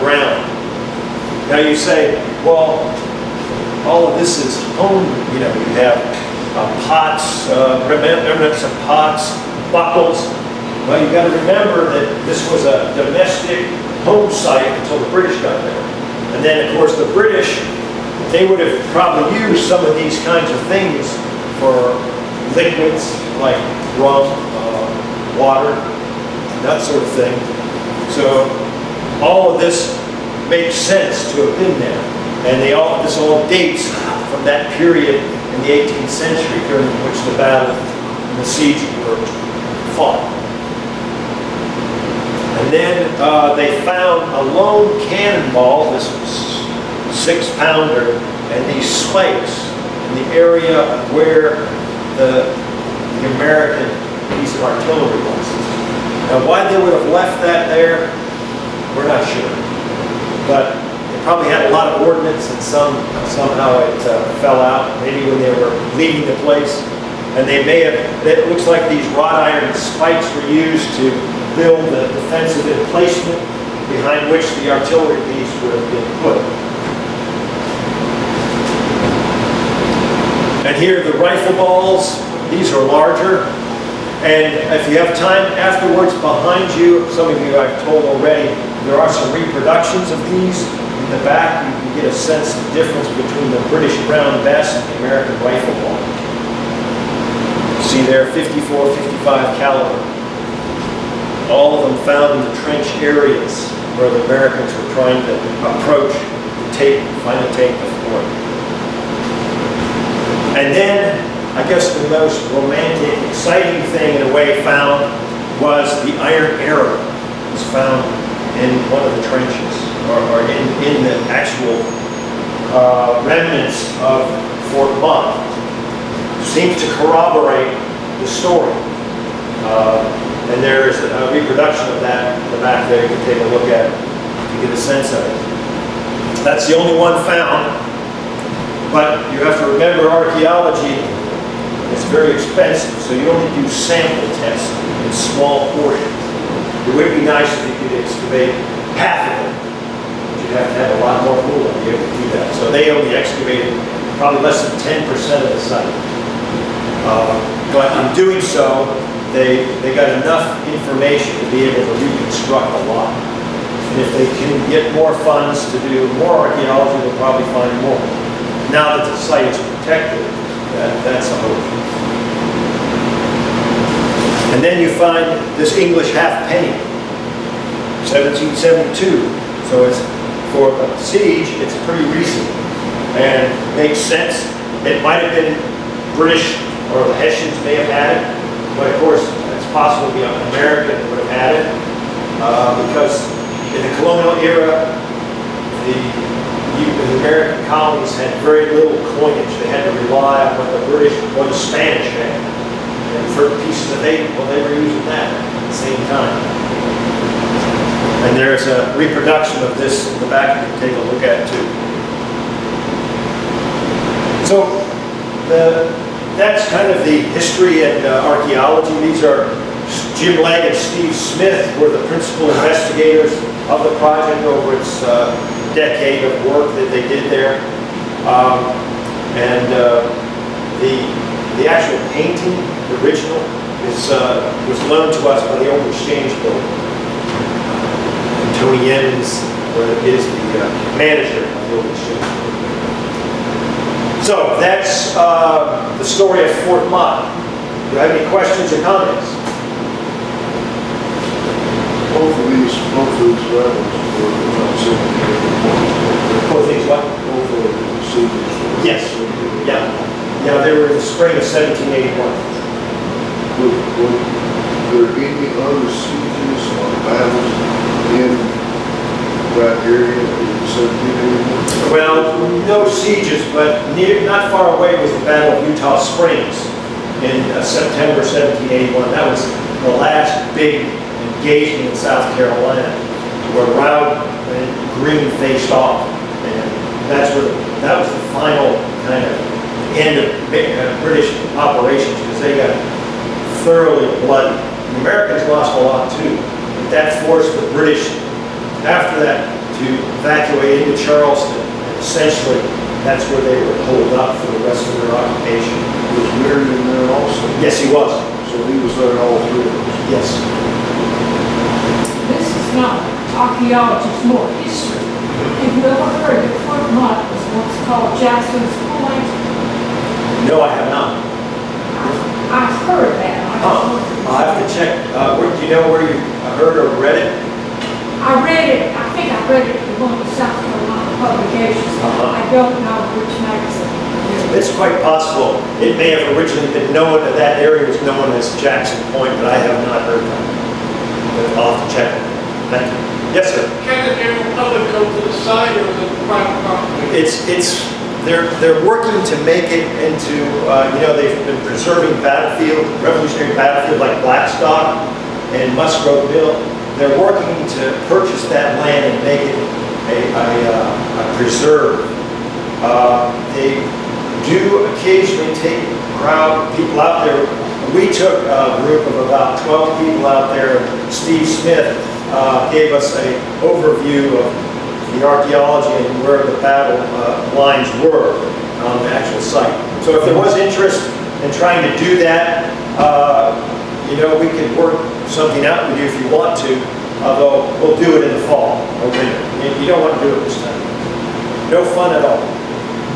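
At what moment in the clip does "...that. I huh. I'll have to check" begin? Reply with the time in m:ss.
5:23.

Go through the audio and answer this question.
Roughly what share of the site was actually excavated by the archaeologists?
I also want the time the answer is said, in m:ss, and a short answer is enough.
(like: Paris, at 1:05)
less than 10%, at 2:34.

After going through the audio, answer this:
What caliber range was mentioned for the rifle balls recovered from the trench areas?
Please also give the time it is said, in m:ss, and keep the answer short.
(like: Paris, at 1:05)
54, 55 caliber, at 1:38.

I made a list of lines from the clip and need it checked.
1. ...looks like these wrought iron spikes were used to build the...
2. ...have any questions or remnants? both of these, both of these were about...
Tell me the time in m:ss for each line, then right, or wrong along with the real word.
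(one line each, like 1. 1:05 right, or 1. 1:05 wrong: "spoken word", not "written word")
1. 1:08 right
2. 4:08 wrong: "comments", not "remnants".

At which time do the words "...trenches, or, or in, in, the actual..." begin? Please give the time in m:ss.
1:59.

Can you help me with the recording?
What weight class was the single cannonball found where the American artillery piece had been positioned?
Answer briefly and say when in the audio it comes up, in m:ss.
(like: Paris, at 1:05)
six-pounder, at 0:47.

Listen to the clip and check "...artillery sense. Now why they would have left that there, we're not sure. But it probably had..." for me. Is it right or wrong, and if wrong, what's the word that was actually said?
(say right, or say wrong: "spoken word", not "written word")
wrong: "license", not "sense".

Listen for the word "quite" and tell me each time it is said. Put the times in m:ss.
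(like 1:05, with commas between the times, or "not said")
5:34.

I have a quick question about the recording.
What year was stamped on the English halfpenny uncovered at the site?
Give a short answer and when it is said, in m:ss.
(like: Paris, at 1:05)
1772, at 2:58.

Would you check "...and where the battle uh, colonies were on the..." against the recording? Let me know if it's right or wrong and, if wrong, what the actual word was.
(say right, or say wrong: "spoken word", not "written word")
wrong: "lines", not "colonies".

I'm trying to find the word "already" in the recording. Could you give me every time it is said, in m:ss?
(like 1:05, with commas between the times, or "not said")
1:28.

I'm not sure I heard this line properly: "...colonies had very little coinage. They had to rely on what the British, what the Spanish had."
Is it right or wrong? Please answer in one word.
right.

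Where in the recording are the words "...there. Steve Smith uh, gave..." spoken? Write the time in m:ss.
6:10.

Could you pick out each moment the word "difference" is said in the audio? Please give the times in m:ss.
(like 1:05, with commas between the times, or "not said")
1:32.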